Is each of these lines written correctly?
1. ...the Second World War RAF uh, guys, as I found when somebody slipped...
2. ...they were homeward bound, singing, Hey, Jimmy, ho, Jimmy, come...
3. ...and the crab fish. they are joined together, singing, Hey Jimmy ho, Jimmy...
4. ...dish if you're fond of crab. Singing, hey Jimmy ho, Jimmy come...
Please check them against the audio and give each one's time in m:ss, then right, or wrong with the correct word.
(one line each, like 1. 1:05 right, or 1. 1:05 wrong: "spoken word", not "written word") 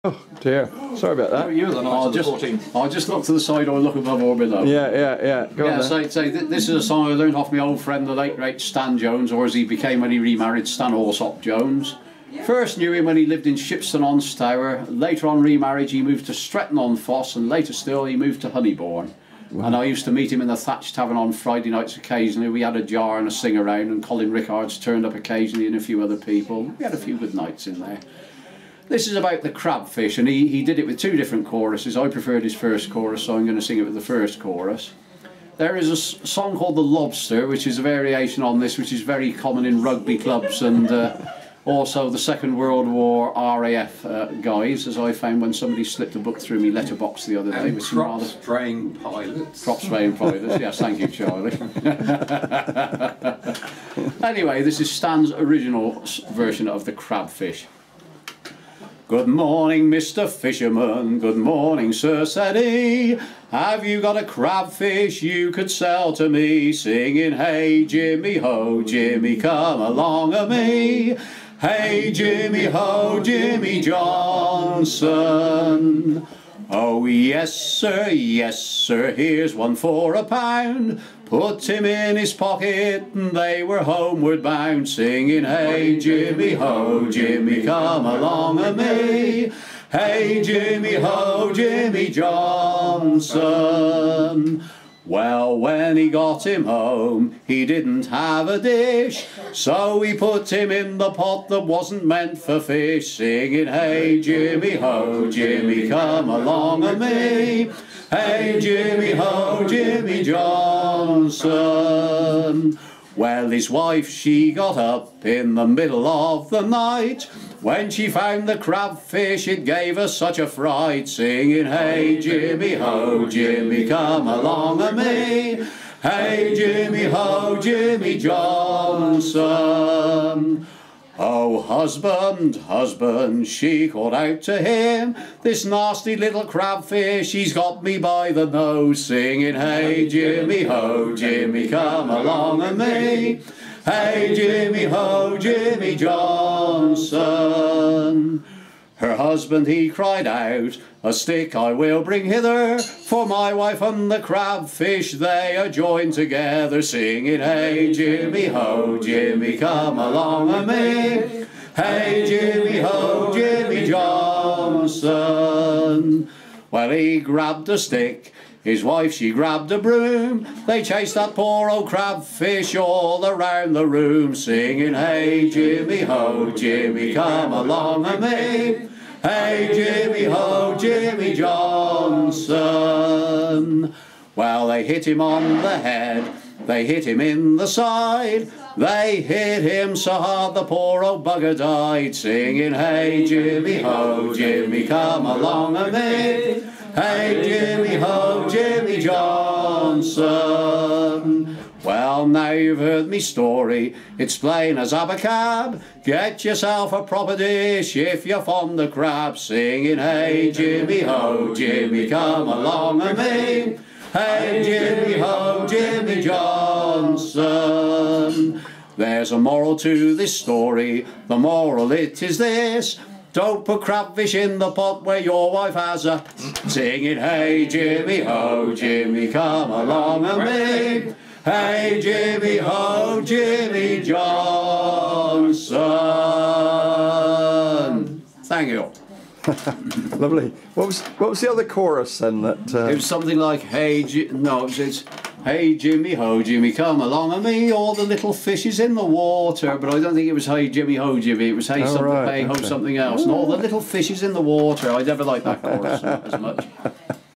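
1. 0:42 right
2. 1:23 right
3. 2:33 right
4. 3:27 right.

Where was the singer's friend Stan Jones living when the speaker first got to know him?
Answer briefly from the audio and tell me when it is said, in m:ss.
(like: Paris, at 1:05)
Shipston on Stour, at 0:13.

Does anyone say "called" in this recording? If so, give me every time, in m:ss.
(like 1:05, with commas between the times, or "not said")
0:36, 2:13.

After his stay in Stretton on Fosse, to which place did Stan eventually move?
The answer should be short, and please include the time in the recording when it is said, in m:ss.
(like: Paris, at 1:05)
Honeybourne, at 0:18.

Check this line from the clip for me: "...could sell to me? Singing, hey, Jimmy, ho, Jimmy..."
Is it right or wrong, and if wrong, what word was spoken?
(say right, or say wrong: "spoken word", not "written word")
right.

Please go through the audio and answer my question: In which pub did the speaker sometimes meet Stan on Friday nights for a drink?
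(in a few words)
Thatch Tavern.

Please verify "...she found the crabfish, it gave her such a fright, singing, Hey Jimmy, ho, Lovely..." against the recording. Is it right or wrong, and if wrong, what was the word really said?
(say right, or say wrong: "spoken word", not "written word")
wrong: "Jimmy", not "Lovely".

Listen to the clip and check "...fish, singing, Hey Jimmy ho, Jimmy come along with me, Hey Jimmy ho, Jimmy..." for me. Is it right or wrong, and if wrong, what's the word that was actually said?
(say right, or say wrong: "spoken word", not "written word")
right.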